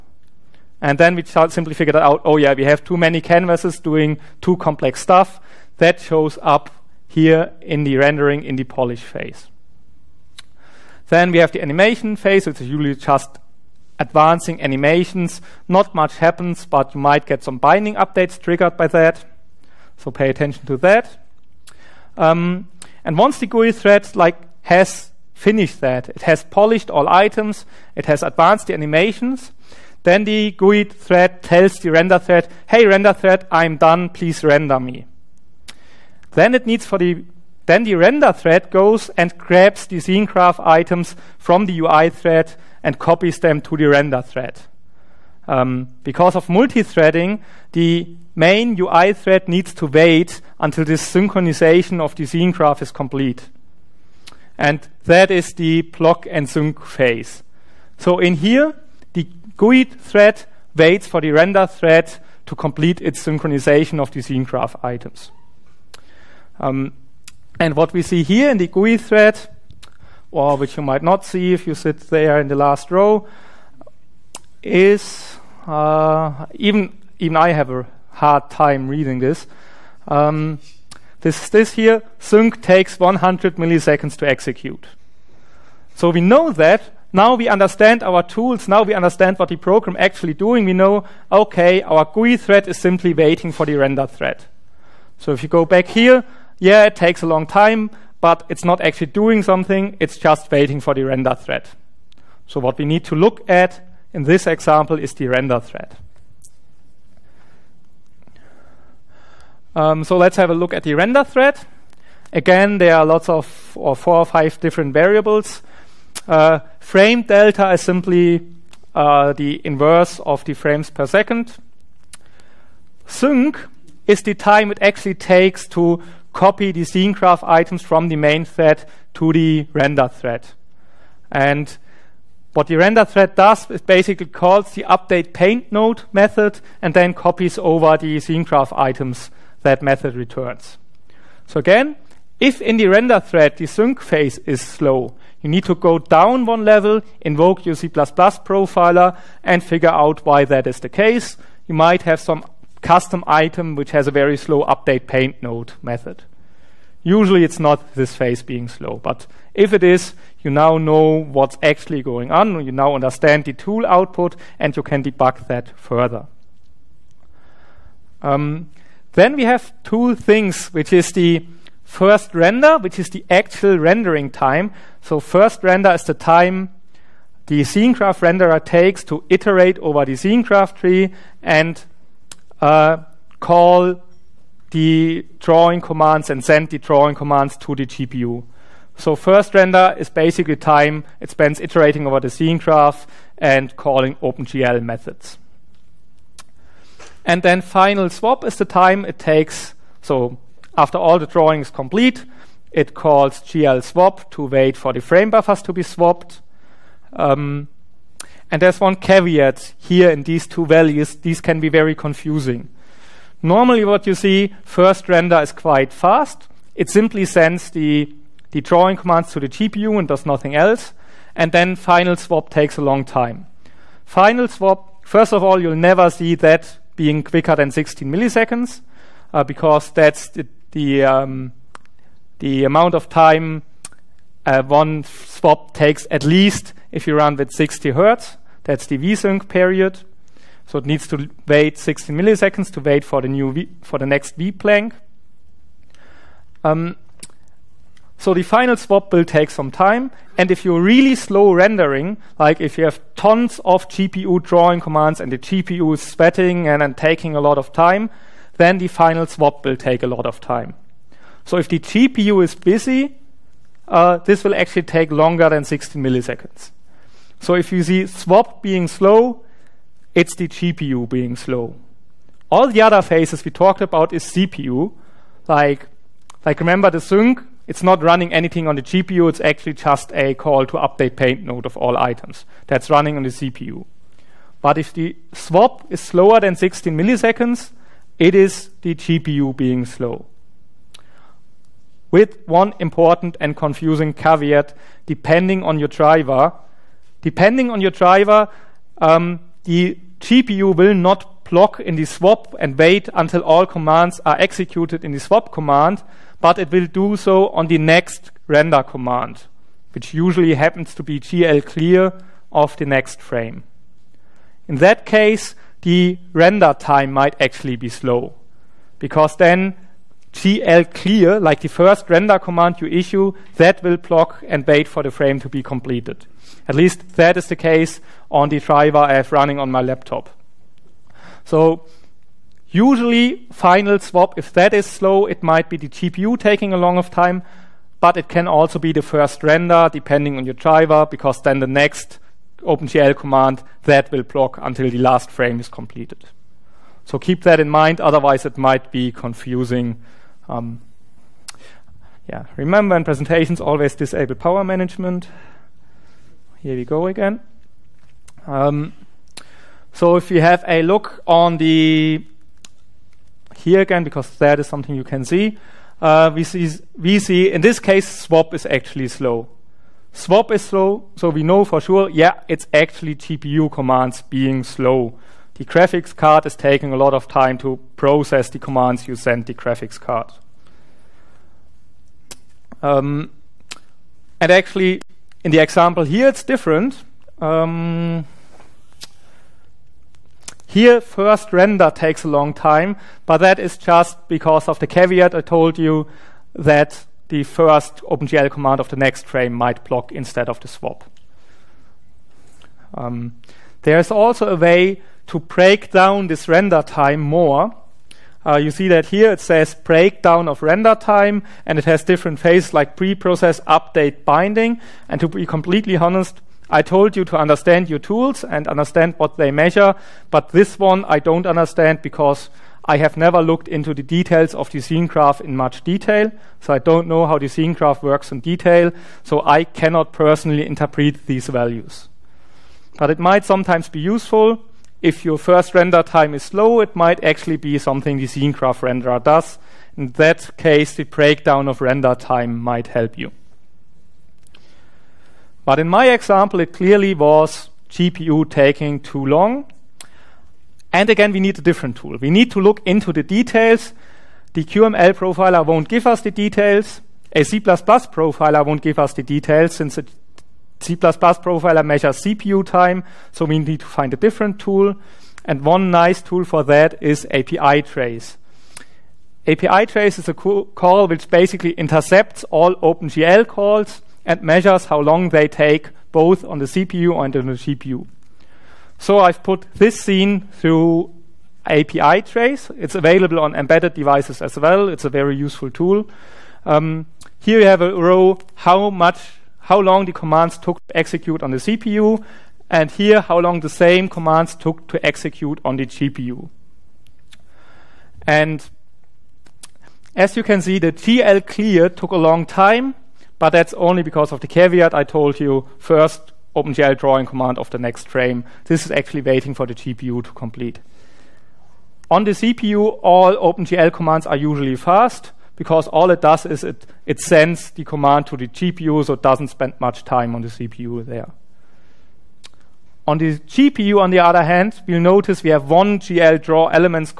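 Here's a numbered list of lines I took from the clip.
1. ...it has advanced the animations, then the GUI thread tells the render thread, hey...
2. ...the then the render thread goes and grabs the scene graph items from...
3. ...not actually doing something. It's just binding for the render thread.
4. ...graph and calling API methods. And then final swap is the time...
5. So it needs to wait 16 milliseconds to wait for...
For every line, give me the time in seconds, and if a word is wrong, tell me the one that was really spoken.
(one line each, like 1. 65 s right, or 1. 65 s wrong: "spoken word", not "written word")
1. 27 s right
2. 36 s right
3. 98 s wrong: "waiting", not "binding"
4. 192 s wrong: "OpenGL", not "API"
5. 240 s right.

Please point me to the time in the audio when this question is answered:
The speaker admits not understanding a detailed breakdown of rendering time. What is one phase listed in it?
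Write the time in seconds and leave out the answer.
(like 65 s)
412 s.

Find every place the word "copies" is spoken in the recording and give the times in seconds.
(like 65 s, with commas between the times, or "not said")
42 s, 137 s.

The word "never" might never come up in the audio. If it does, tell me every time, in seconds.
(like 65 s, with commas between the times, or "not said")
225 s, 423 s.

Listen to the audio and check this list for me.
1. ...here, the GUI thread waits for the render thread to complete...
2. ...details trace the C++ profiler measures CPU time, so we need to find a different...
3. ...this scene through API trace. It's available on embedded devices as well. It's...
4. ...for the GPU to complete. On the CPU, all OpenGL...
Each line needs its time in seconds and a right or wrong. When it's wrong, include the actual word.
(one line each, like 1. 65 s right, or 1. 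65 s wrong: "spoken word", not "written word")
1. 58 s right
2. 459 s wrong: "since", not "trace"
3. 479 s right
4. 509 s right.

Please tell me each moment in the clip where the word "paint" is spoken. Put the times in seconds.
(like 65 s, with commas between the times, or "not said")
135 s, 155 s, 281 s.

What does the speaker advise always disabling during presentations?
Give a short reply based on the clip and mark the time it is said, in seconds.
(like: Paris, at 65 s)
power management, at 354 s.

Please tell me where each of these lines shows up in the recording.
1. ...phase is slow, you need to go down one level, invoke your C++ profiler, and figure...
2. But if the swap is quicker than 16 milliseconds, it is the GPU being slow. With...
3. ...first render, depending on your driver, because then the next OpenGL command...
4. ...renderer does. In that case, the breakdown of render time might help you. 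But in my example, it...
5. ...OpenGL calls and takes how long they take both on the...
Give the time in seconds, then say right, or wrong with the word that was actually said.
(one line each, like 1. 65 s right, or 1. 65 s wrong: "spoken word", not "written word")
1. 143 s right
2. 284 s wrong: "slower", not "quicker"
3. 339 s right
4. 438 s right
5. 472 s wrong: "measures", not "takes".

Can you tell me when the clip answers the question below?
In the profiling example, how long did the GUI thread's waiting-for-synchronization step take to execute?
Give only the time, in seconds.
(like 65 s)
82 s.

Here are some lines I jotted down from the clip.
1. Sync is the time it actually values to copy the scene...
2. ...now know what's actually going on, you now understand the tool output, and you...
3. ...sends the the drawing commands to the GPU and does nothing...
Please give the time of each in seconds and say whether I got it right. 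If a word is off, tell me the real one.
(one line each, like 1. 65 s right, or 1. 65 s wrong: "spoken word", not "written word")
1. 123 s wrong: "takes", not "values"
2. 160 s right
3. 217 s right.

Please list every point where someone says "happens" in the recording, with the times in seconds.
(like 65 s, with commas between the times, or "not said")
16 s, 310 s.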